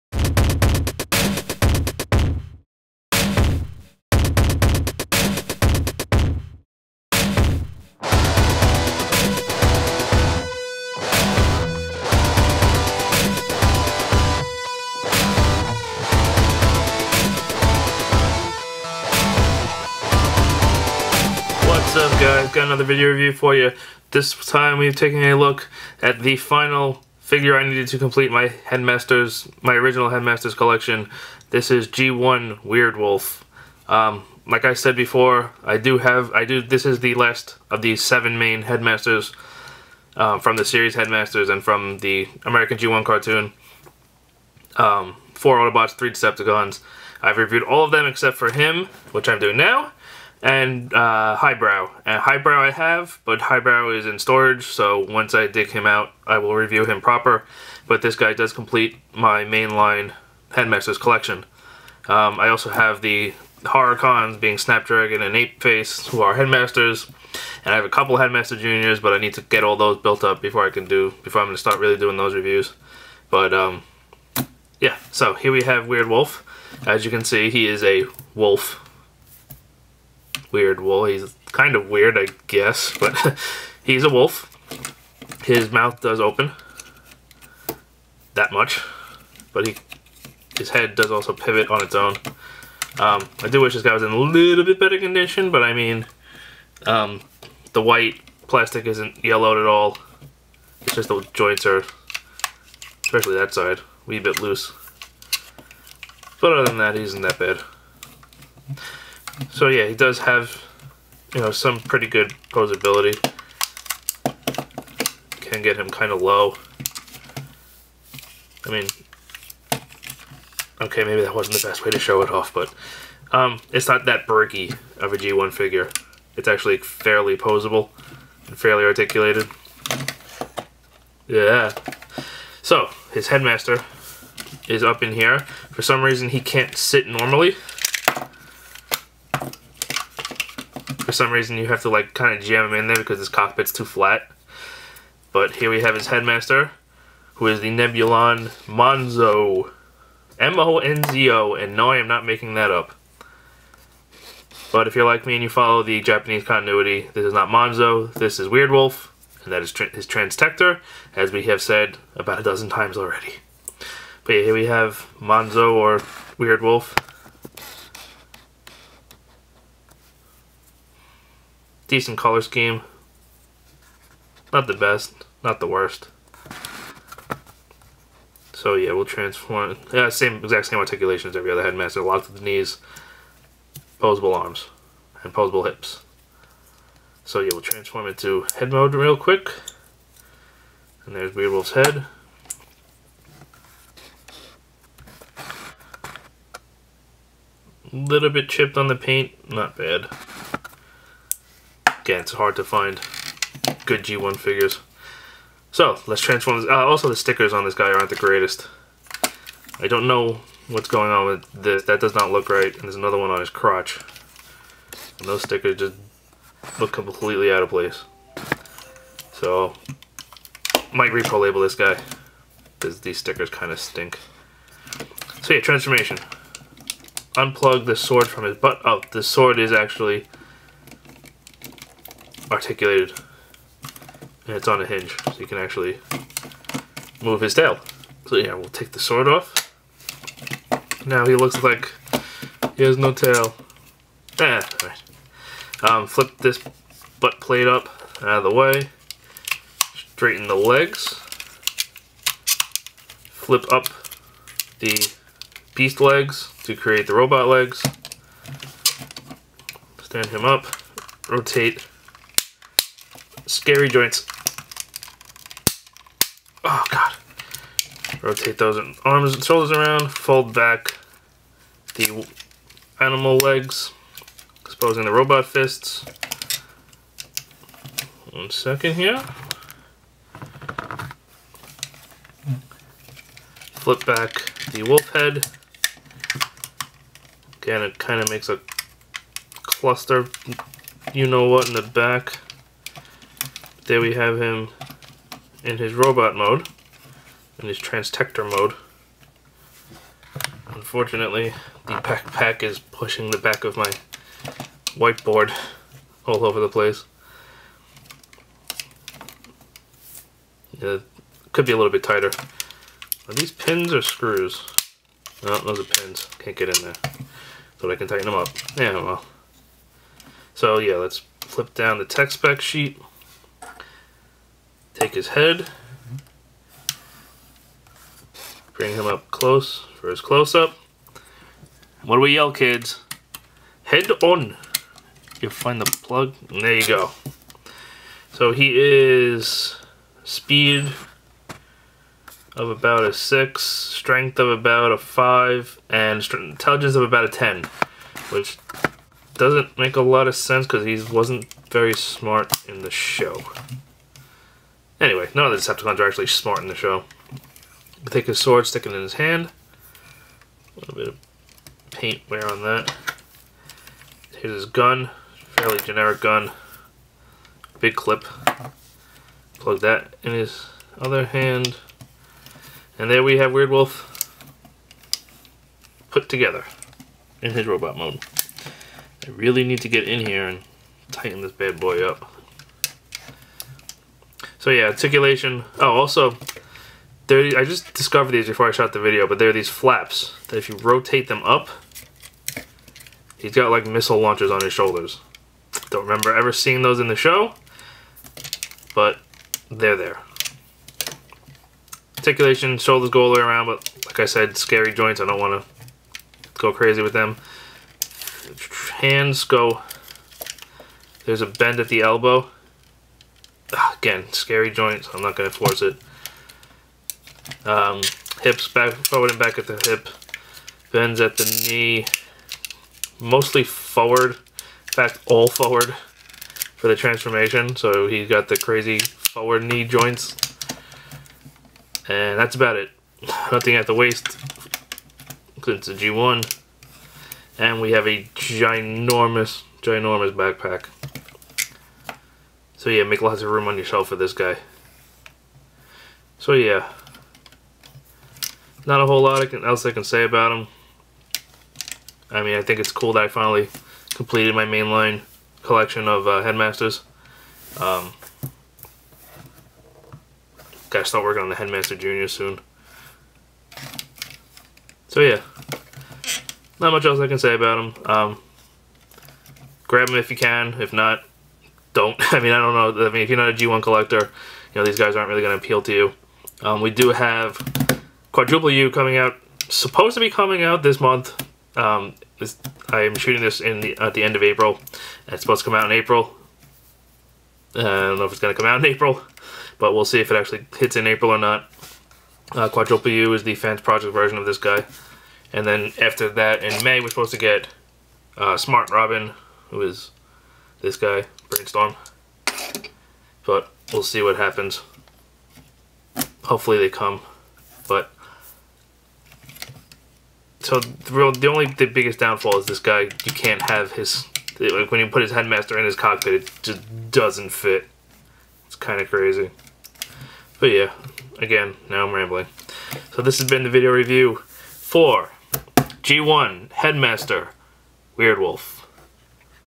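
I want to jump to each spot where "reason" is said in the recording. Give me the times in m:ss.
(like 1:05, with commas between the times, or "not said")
2:16, 2:21.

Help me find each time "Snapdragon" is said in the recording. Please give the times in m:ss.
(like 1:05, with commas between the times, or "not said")
1:04.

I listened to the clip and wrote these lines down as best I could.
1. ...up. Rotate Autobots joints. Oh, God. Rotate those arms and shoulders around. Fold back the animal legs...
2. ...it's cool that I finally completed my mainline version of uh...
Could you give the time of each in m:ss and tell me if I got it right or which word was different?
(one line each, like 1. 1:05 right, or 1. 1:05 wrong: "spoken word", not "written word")
1. 4:20 wrong: "Scary", not "Autobots"
2. 7:32 wrong: "collection", not "version".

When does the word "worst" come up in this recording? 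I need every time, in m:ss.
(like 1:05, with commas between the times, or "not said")
2:55.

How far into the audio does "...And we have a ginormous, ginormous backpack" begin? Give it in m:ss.
7:17.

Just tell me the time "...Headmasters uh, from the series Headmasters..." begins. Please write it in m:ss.
0:38.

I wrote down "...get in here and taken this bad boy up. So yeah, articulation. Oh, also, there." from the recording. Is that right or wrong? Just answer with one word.
wrong.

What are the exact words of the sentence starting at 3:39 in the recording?
So, might repro label this guy.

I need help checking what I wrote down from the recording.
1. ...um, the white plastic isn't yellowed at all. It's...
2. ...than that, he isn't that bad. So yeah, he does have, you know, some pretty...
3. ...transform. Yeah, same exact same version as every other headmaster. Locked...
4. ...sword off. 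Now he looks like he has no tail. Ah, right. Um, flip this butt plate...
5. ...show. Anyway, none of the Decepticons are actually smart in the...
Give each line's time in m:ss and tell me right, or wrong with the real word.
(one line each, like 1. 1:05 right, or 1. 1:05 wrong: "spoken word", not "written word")
1. 1:36 right
2. 1:46 right
3. 2:59 wrong: "articulation", not "version"
4. 3:58 right
5. 5:52 right.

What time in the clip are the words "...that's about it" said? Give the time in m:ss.
7:12.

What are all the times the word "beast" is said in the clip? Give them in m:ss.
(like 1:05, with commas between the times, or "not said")
4:15.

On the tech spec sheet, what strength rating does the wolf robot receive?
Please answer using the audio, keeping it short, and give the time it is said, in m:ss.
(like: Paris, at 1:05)
5, at 5:44.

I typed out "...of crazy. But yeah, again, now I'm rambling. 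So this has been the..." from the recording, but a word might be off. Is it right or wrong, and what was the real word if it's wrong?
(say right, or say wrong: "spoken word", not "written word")
right.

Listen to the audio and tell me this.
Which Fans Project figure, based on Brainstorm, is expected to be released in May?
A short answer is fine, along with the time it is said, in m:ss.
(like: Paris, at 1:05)
Smart Robin, at 8:18.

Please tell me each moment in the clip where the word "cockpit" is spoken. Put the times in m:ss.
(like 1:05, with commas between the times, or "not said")
2:23, 8:35.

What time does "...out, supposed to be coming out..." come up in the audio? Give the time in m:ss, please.
7:59.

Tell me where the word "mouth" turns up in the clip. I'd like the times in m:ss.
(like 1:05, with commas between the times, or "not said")
1:25.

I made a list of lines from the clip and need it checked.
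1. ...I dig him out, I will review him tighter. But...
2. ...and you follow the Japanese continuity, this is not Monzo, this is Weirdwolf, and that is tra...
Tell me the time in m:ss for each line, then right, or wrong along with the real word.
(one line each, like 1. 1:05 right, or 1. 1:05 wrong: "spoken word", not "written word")
1. 0:55 wrong: "proper", not "tighter"
2. 2:35 right.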